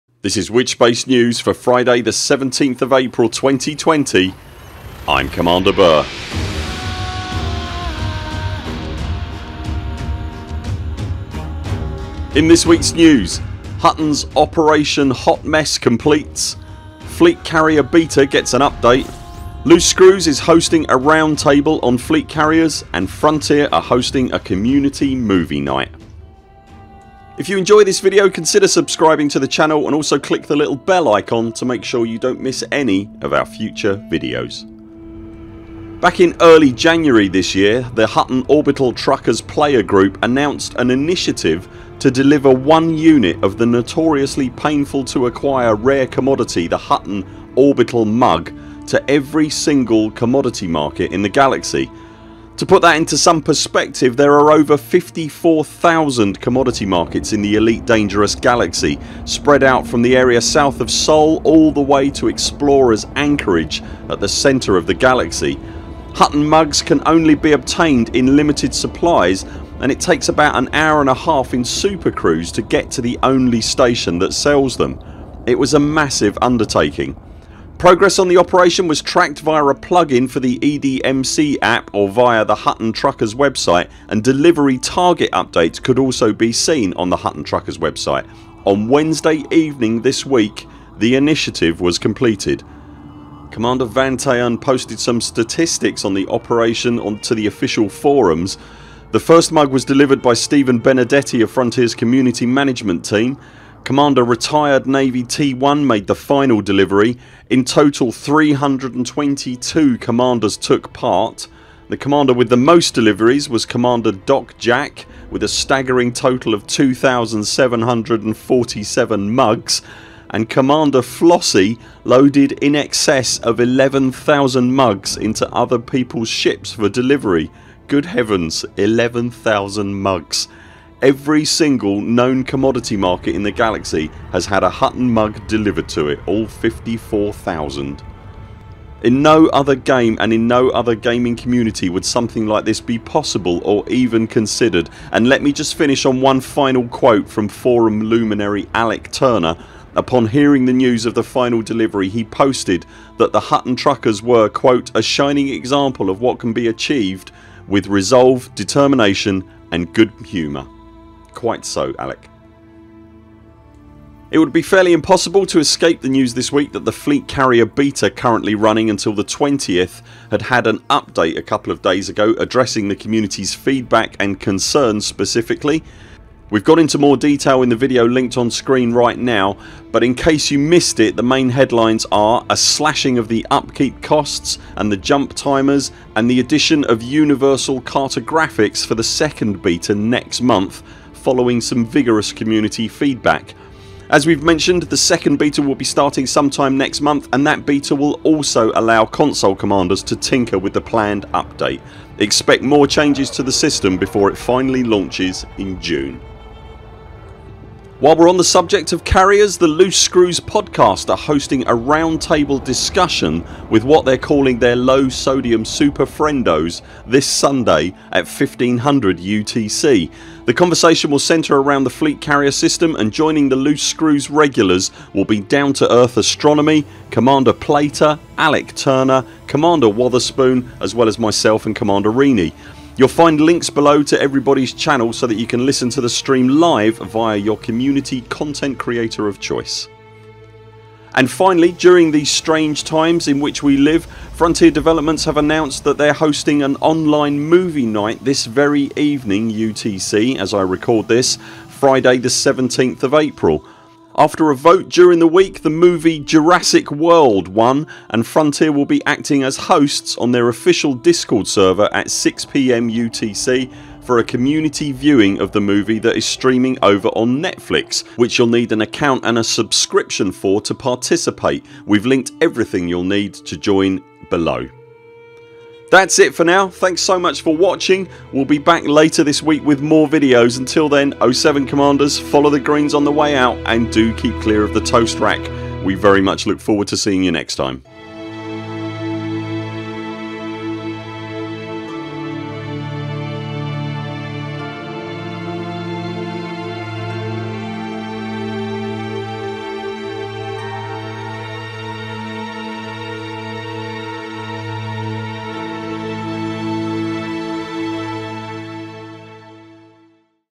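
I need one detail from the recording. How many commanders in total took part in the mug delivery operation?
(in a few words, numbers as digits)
322.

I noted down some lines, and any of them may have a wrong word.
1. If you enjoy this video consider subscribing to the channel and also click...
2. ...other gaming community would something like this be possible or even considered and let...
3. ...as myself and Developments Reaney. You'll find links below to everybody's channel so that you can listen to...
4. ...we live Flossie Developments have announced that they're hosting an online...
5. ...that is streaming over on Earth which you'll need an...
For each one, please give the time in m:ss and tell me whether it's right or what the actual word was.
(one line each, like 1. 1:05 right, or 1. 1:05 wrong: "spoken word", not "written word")
1. 0:27 right
2. 2:20 right
3. 3:51 wrong: "Commander", not "Developments"
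4. 4:03 wrong: "Frontier", not "Flossie"
5. 4:25 wrong: "Netflix", not "Earth".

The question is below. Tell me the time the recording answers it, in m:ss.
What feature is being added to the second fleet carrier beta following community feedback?
3:07.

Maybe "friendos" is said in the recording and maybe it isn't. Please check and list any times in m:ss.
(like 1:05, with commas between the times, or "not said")
3:36.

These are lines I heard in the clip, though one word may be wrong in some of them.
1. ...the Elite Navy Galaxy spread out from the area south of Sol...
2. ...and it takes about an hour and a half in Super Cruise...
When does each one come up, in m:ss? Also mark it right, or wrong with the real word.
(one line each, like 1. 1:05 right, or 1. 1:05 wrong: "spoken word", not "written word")
1. 0:57 wrong: "Dangerous", not "Navy"
2. 1:09 right.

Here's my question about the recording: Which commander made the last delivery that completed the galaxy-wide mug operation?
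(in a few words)
Commander retired Navy T1.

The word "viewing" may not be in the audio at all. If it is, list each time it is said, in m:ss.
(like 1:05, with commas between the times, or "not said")
4:24.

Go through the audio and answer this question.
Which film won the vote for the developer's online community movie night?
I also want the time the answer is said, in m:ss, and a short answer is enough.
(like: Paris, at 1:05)
Jurassic World, at 4:16.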